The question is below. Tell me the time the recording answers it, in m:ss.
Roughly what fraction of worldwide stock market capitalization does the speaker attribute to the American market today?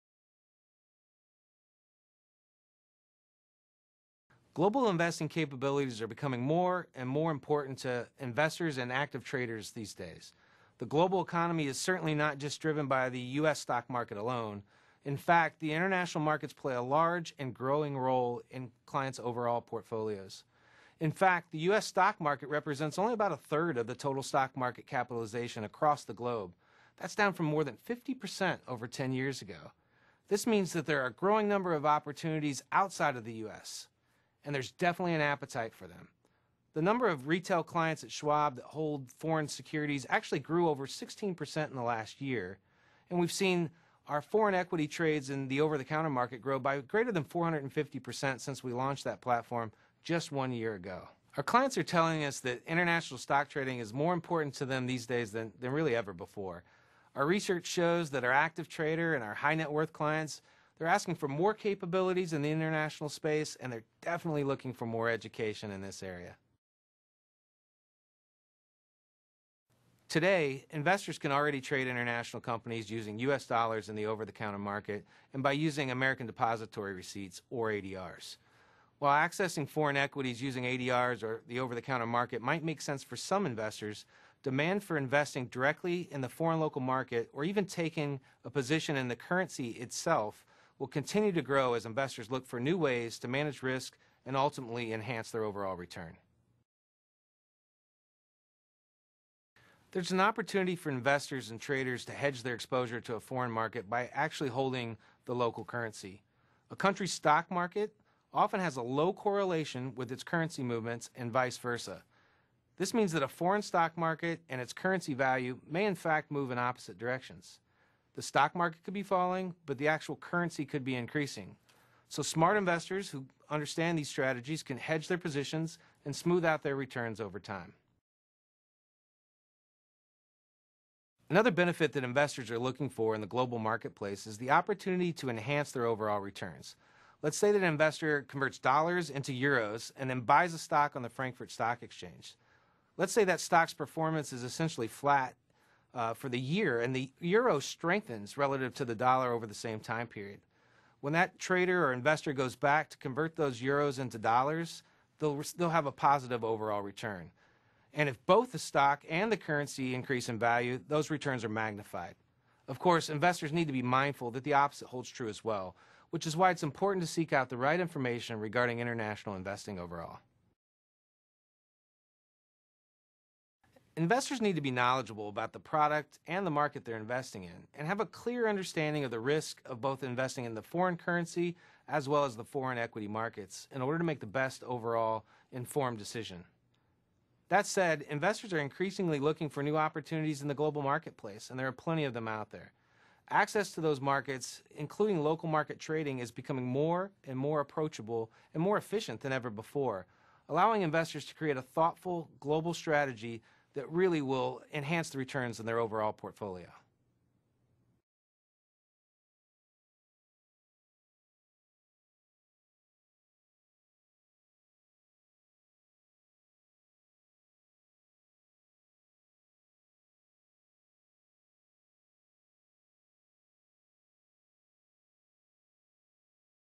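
0:23.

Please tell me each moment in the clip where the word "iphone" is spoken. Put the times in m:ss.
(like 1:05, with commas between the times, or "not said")
not said.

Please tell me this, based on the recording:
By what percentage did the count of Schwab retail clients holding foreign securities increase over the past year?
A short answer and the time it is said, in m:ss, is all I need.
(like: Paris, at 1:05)
over 16%, at 0:40.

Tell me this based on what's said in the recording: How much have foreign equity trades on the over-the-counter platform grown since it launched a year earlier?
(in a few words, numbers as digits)
greater than 450%.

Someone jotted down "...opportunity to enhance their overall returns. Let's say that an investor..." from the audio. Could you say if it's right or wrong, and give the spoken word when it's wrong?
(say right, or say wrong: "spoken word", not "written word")
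right.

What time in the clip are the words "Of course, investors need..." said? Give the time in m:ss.
2:42.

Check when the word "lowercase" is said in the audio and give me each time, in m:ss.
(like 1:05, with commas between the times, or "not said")
not said.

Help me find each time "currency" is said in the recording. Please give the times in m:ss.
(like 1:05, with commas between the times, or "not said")
1:29, 1:45, 1:50, 1:54, 2:00, 2:39, 3:00.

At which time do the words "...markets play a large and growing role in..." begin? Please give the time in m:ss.
0:16.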